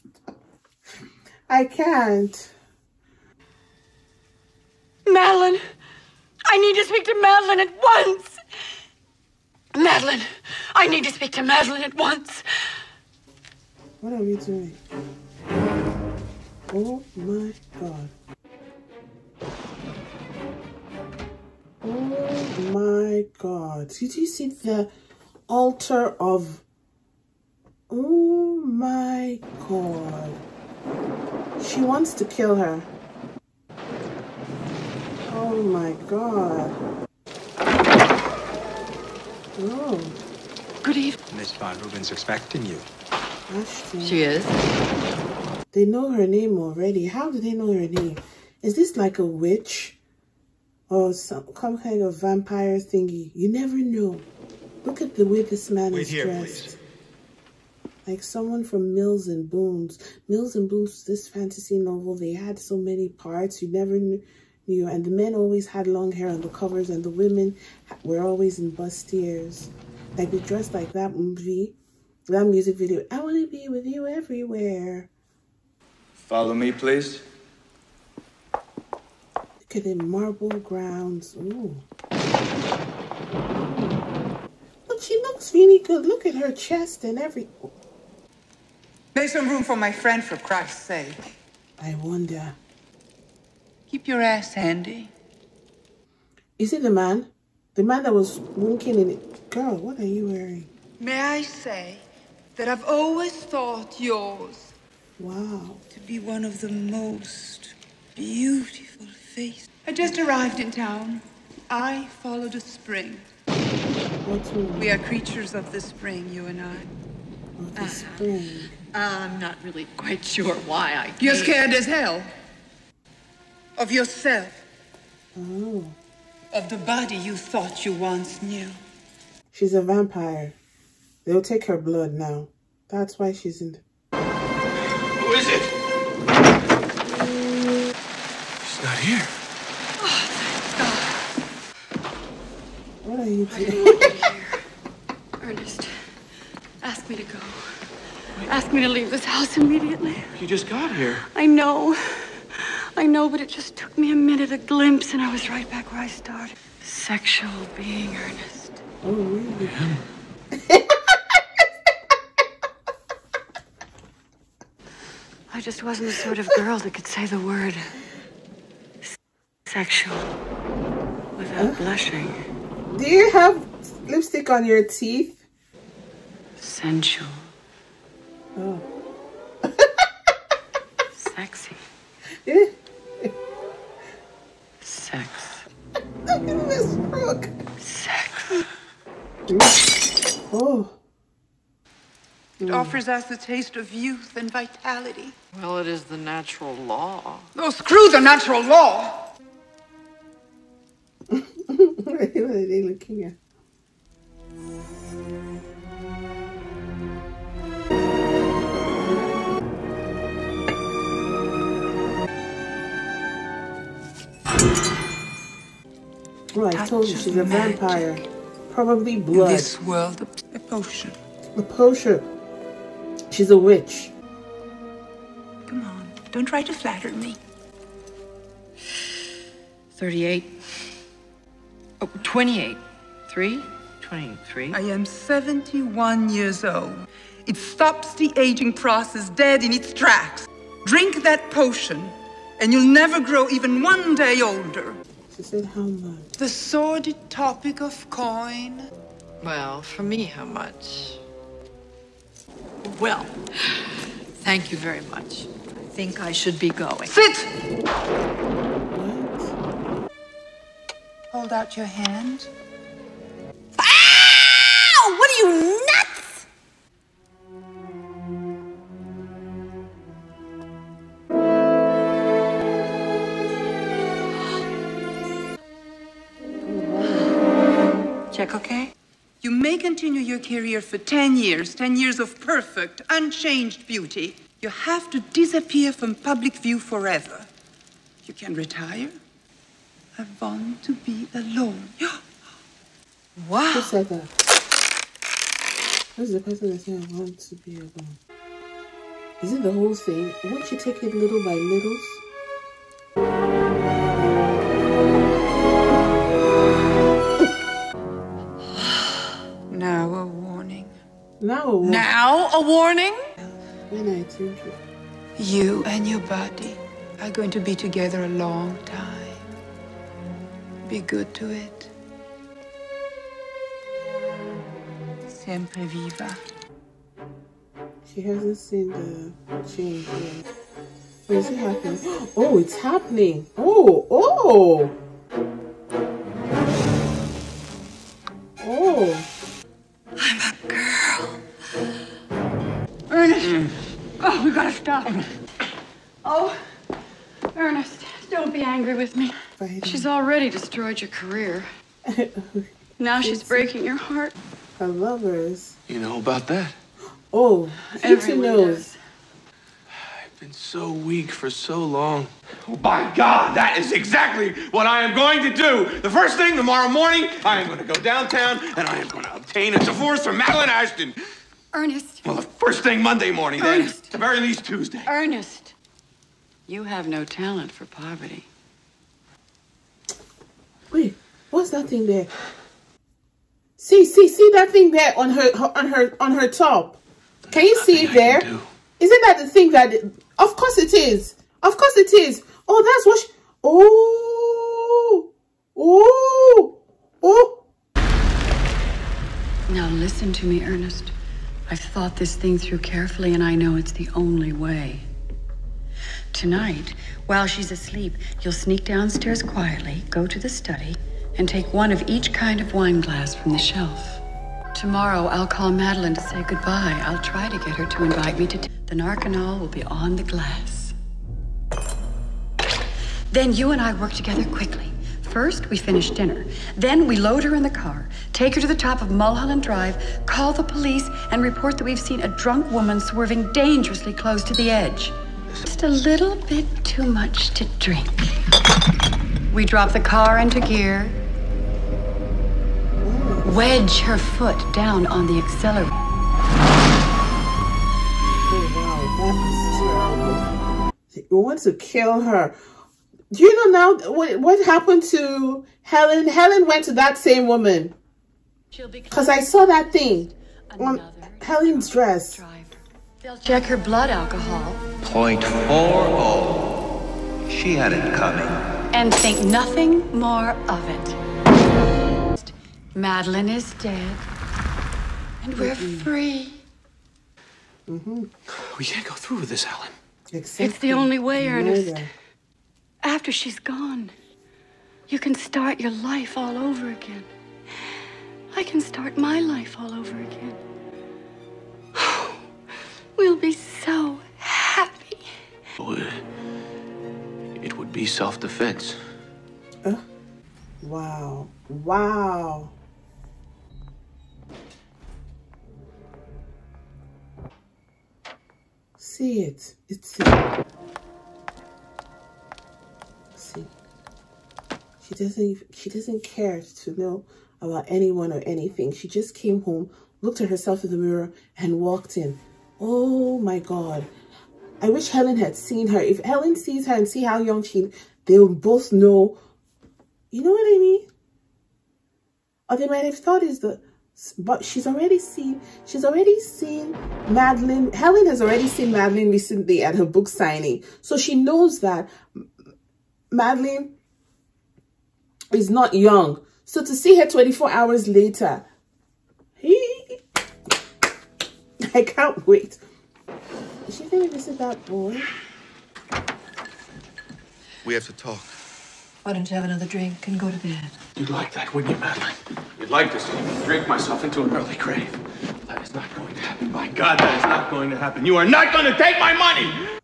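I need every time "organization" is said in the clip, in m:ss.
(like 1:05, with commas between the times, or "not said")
not said.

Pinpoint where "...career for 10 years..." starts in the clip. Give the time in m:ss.
4:40.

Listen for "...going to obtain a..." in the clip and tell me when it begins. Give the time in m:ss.
6:09.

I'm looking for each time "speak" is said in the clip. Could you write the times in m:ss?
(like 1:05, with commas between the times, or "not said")
0:06, 0:11.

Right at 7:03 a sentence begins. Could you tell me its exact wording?
Then you and I work together quickly.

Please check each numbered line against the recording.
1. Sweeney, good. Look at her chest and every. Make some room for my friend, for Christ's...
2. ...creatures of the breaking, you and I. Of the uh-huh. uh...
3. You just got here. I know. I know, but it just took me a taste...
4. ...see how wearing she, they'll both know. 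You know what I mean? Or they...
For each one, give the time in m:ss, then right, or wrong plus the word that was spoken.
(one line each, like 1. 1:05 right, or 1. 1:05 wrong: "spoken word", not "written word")
1. 1:25 right
2. 1:54 wrong: "spring", not "breaking"
3. 2:30 wrong: "minute", not "taste"
4. 8:47 wrong: "young", not "wearing".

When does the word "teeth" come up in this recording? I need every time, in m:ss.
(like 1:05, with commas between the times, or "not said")
2:54.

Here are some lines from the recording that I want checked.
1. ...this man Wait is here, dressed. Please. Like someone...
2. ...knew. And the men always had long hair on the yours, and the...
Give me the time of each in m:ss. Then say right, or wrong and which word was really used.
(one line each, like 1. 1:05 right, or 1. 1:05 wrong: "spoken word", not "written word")
1. 0:55 right
2. 1:03 wrong: "covers", not "yours".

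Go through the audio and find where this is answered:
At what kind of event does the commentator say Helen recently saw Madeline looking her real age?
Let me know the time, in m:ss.
9:00.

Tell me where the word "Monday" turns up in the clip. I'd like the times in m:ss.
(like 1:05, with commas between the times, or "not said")
6:13.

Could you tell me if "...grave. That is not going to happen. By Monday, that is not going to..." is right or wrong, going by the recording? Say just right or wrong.
wrong.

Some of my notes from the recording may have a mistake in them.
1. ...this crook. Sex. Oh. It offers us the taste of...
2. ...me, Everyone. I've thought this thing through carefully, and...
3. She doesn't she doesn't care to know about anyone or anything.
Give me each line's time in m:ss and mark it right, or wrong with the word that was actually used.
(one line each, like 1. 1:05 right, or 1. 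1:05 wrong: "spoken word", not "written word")
1. 3:06 right
2. 6:40 wrong: "Ernest", not "Everyone"
3. 8:35 right.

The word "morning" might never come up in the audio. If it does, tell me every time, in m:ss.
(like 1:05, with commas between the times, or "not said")
6:06, 6:13.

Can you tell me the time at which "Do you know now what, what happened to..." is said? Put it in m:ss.
7:33.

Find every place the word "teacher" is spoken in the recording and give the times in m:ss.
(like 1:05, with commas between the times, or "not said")
not said.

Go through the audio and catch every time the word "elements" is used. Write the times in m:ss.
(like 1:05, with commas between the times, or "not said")
not said.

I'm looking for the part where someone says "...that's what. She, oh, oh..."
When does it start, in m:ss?
6:32.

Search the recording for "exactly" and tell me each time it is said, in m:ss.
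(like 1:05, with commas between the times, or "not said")
6:03, 8:00.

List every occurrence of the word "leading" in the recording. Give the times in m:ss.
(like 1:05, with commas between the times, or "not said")
not said.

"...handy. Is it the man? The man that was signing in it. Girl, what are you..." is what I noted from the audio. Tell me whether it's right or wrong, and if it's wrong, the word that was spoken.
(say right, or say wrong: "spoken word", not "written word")
wrong: "winking", not "signing".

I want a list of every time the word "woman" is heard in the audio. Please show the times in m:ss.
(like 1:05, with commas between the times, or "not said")
7:12, 7:37.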